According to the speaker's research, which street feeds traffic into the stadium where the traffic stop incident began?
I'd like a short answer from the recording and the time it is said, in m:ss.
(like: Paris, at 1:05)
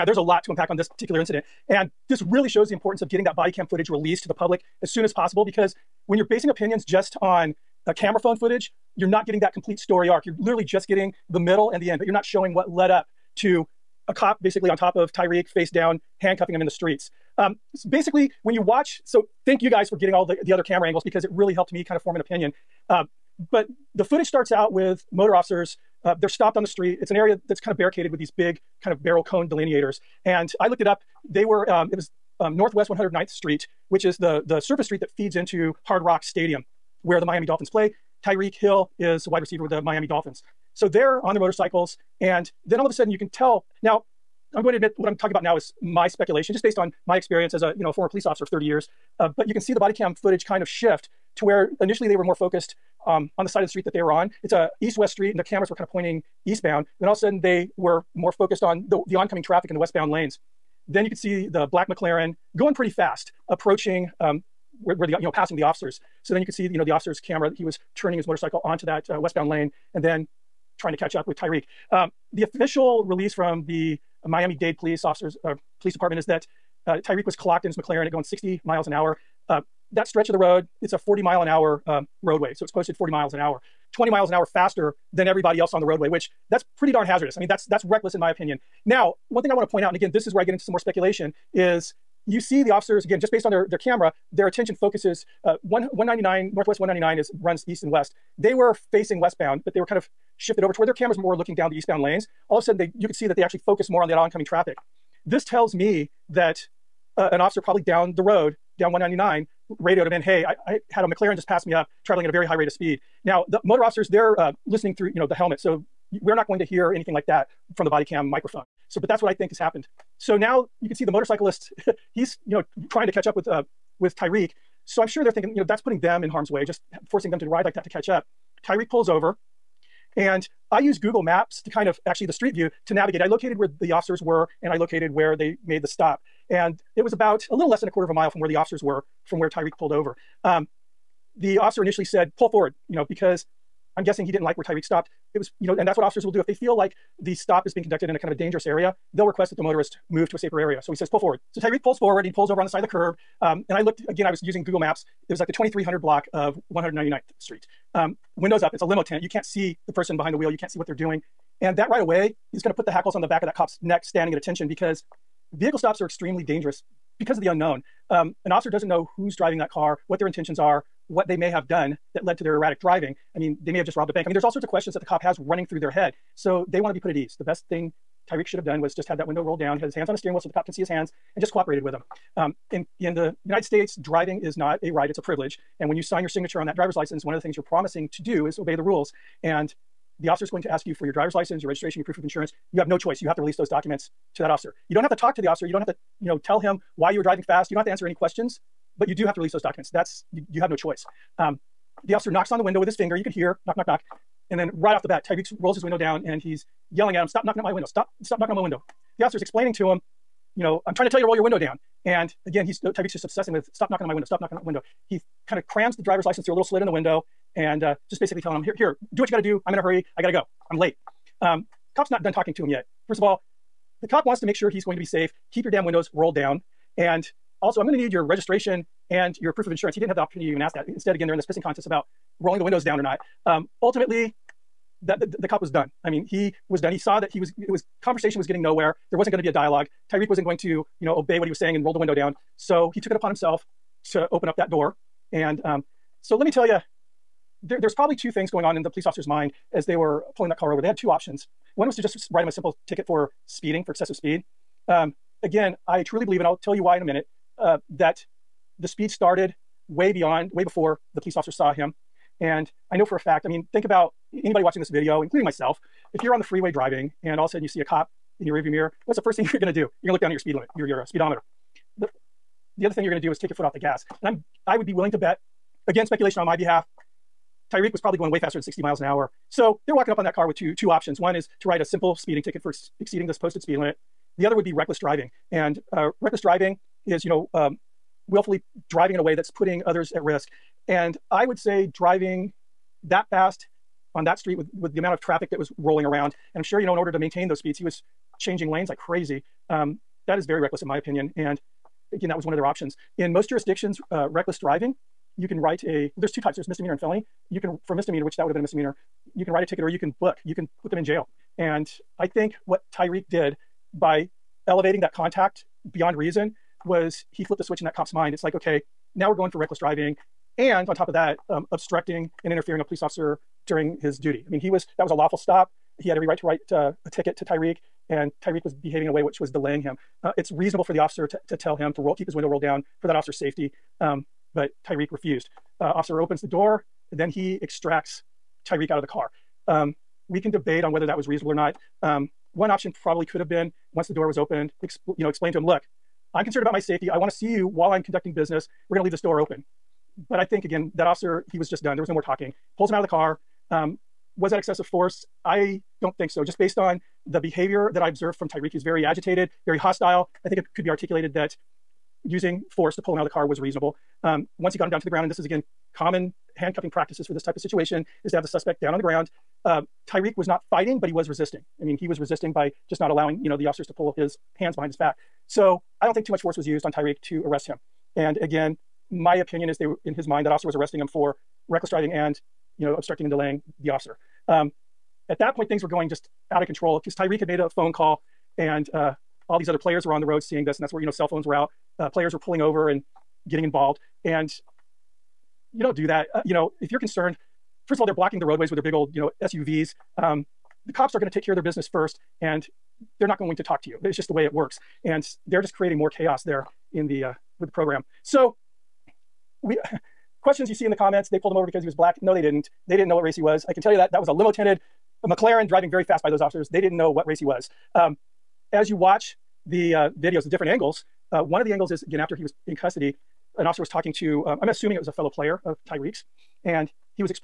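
Northwest 109th Street, at 0:32.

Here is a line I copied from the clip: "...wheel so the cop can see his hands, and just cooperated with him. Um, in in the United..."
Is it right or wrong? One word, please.
right.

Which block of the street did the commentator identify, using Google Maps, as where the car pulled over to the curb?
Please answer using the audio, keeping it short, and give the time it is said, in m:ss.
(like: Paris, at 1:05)
2300 block, at 2:35.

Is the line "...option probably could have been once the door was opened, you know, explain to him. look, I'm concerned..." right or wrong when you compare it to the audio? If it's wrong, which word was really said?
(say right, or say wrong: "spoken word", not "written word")
right.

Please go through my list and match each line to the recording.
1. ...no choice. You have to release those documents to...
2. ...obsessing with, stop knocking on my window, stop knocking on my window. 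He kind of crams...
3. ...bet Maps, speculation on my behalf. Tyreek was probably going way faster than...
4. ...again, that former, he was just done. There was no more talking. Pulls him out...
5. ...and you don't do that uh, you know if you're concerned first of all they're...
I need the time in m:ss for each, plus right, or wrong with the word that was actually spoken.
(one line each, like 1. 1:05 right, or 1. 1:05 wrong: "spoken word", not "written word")
1. 3:12 right
2. 3:33 right
3. 4:35 wrong: "Again", not "Maps"
4. 5:50 wrong: "officer", not "former"
5. 6:34 right.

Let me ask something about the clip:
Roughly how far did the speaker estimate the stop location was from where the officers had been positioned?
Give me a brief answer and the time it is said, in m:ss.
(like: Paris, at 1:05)
a quarter of a mile, at 2:17.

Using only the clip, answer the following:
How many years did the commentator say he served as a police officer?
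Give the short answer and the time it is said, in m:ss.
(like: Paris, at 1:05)
30, at 0:48.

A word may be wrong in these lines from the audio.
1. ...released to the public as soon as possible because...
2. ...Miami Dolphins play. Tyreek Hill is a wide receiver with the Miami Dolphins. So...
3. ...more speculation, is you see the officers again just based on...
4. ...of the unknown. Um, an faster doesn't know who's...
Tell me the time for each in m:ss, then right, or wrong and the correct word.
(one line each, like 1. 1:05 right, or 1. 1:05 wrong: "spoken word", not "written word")
1. 0:03 right
2. 0:37 right
3. 1:30 right
4. 2:47 wrong: "officer", not "faster".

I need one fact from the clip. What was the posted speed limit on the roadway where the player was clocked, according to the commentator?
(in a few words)
40 miles an hour.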